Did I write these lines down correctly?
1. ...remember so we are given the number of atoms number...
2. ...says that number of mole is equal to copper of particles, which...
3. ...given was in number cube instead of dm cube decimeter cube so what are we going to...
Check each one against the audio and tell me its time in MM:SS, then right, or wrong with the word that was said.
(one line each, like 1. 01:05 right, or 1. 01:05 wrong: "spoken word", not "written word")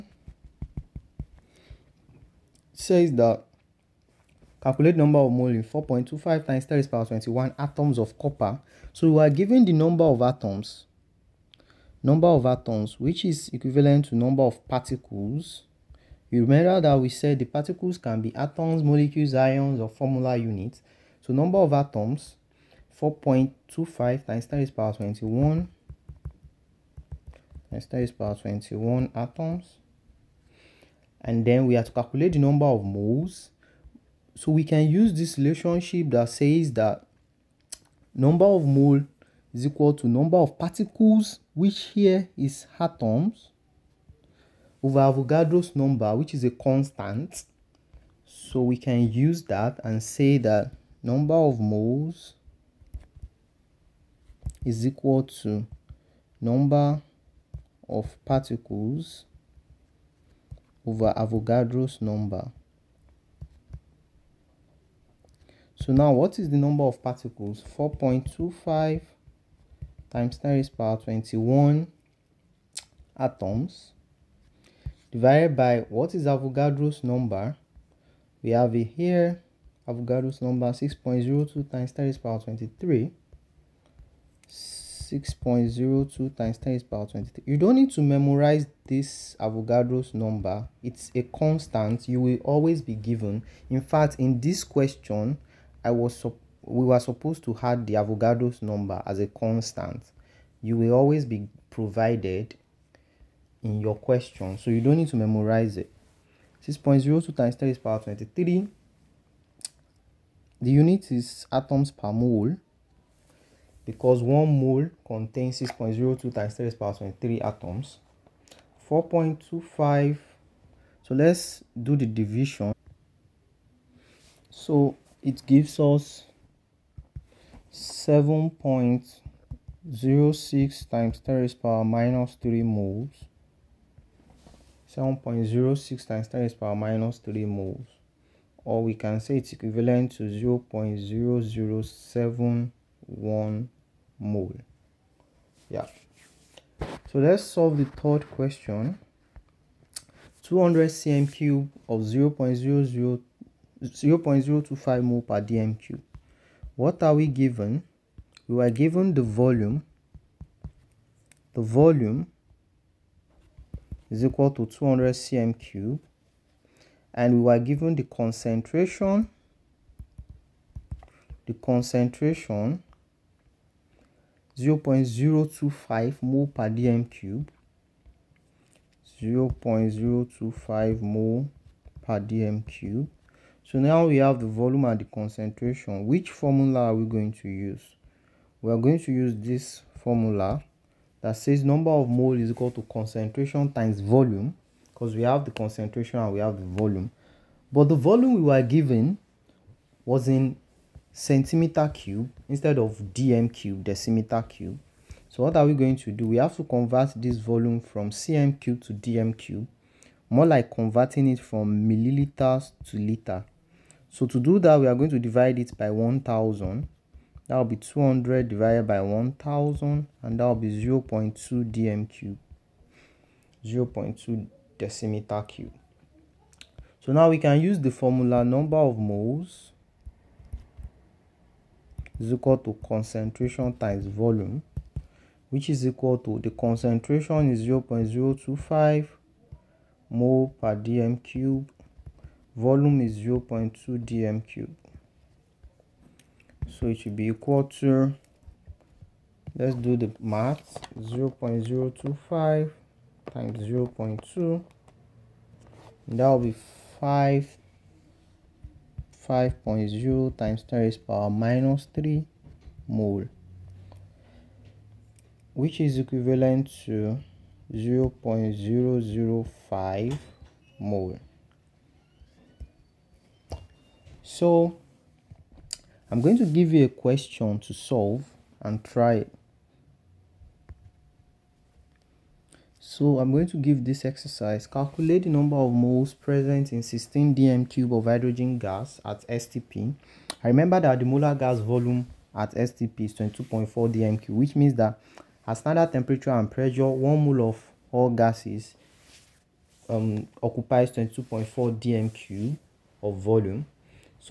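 1. 00:08 wrong: "copper", not "remember"
2. 00:36 wrong: "number", not "copper"
3. 03:18 wrong: "centimeter", not "number".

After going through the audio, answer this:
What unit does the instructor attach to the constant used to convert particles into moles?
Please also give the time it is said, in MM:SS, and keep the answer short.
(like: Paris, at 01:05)
atoms per mole, at 01:51.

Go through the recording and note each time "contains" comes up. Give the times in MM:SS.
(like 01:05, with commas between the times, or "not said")
01:55.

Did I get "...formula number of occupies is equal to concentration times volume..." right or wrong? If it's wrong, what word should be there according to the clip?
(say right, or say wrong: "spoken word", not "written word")
wrong: "moles", not "occupies".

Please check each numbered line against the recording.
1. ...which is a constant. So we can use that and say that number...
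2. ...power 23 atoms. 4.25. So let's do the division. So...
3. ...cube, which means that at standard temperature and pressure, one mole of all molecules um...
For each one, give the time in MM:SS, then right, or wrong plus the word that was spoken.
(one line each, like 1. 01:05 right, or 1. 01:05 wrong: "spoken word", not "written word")
1. 00:46 right
2. 01:56 right
3. 04:54 wrong: "gases", not "molecules".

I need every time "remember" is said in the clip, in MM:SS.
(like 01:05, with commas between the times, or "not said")
00:16, 04:50.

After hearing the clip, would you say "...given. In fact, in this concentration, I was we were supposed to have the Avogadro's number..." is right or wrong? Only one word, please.
wrong.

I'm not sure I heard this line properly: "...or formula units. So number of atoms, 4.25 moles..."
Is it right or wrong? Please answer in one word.
wrong.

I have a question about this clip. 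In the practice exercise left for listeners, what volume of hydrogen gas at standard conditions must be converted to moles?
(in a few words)
16 dm³.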